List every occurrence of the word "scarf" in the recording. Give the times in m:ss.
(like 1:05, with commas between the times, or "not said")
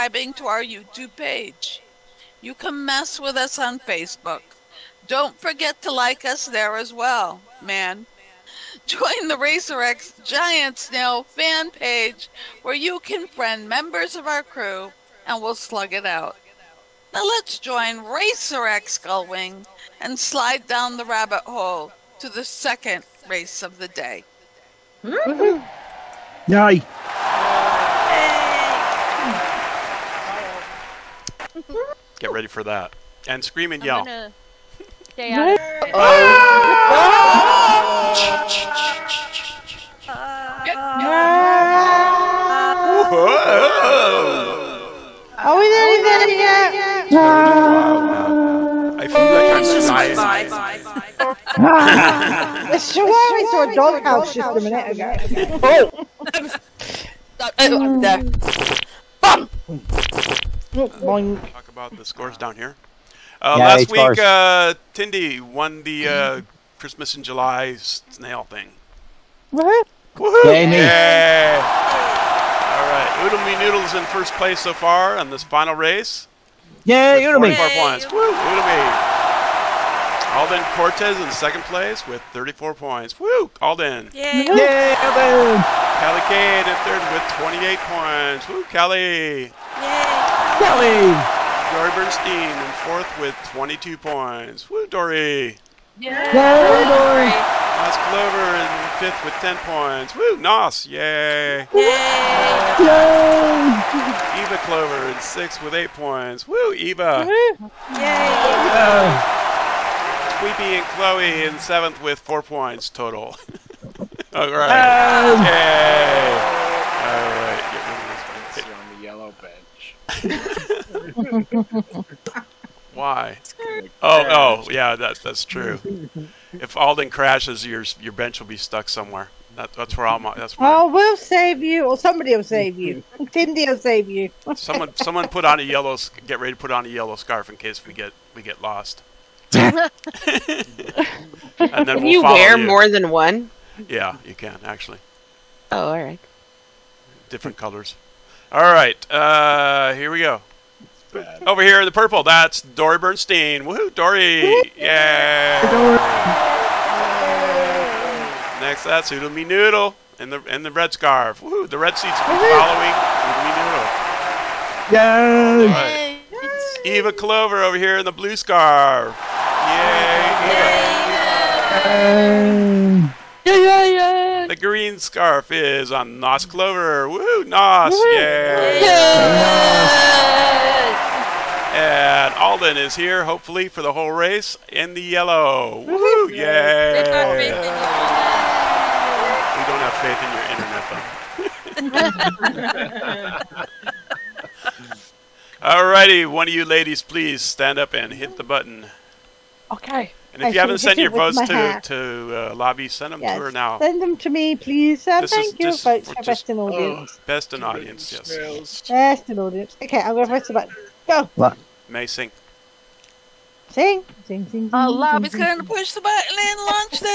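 2:17, 2:40, 2:48, 2:54.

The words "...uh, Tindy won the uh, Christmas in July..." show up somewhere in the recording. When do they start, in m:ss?
1:04.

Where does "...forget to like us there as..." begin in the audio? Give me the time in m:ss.
0:05.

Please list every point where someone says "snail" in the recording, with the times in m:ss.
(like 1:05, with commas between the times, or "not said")
0:10, 1:07.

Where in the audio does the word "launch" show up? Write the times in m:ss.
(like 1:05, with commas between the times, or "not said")
3:36.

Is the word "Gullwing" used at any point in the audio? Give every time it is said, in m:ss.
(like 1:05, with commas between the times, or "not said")
0:19.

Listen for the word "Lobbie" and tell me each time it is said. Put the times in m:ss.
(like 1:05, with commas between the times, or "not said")
3:22, 3:34.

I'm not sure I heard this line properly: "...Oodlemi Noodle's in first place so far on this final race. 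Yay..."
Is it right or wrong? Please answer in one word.
right.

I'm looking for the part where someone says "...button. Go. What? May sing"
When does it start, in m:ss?
3:30.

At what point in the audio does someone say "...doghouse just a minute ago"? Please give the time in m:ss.
0:53.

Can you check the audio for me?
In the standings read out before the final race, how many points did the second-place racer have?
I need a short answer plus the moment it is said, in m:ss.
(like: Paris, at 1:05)
34, at 1:22.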